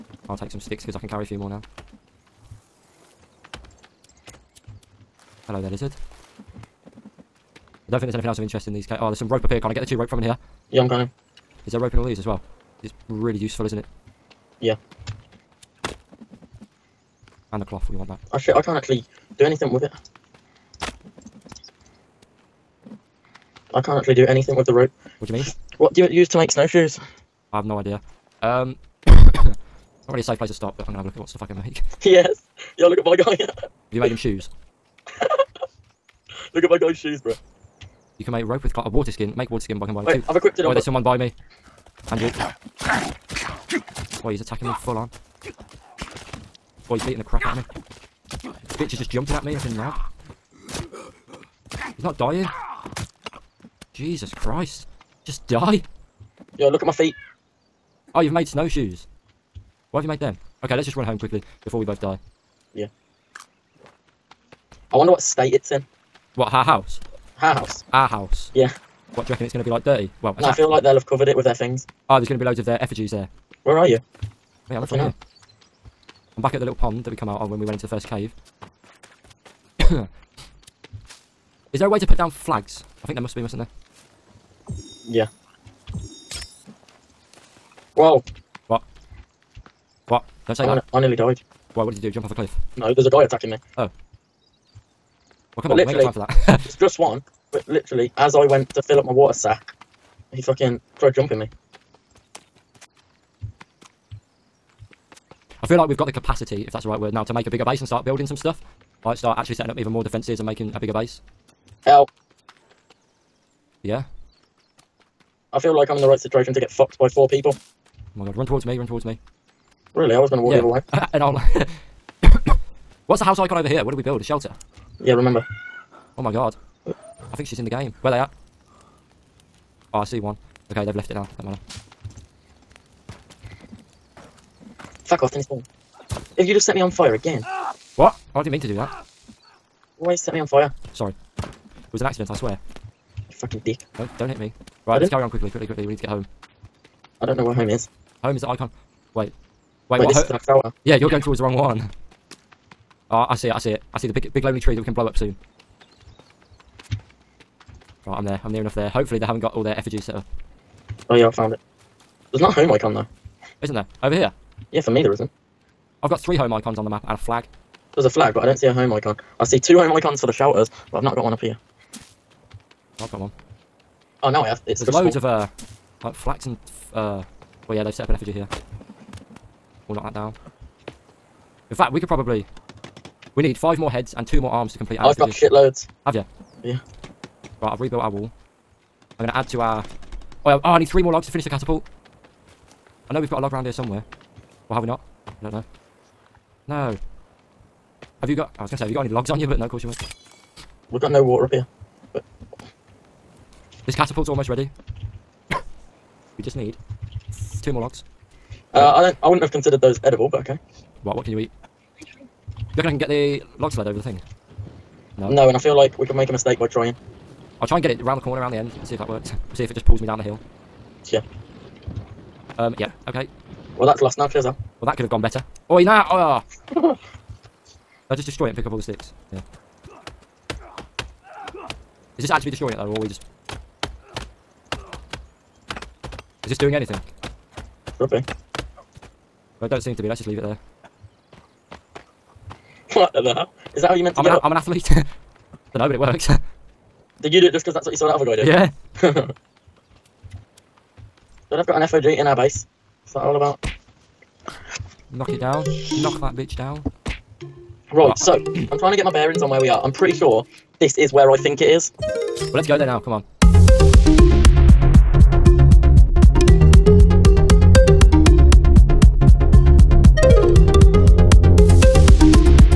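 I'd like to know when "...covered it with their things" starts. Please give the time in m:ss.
1:11.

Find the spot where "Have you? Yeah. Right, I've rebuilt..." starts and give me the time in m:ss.
3:06.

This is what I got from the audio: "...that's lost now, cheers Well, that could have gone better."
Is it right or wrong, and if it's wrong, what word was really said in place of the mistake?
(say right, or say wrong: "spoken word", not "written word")
right.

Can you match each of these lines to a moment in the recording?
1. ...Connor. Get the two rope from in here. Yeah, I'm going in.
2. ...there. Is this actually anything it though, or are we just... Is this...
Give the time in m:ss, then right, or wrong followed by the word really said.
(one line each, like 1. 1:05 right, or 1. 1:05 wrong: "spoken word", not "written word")
1. 0:09 right
2. 3:49 wrong: "destroying", not "anything".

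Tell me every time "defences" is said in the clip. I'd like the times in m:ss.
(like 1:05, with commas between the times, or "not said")
1:50.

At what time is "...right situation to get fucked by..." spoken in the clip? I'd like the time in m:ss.
1:56.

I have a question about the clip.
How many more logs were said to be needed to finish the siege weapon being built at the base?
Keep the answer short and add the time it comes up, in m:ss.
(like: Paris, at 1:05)
3, at 3:10.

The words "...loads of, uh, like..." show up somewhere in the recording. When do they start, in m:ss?
2:54.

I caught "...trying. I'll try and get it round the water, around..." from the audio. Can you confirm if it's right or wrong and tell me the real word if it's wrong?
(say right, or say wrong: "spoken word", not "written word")
wrong: "corner", not "water".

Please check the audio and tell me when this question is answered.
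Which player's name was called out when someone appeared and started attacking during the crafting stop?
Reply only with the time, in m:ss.
0:42.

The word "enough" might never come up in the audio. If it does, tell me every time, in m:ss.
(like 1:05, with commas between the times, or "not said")
2:38.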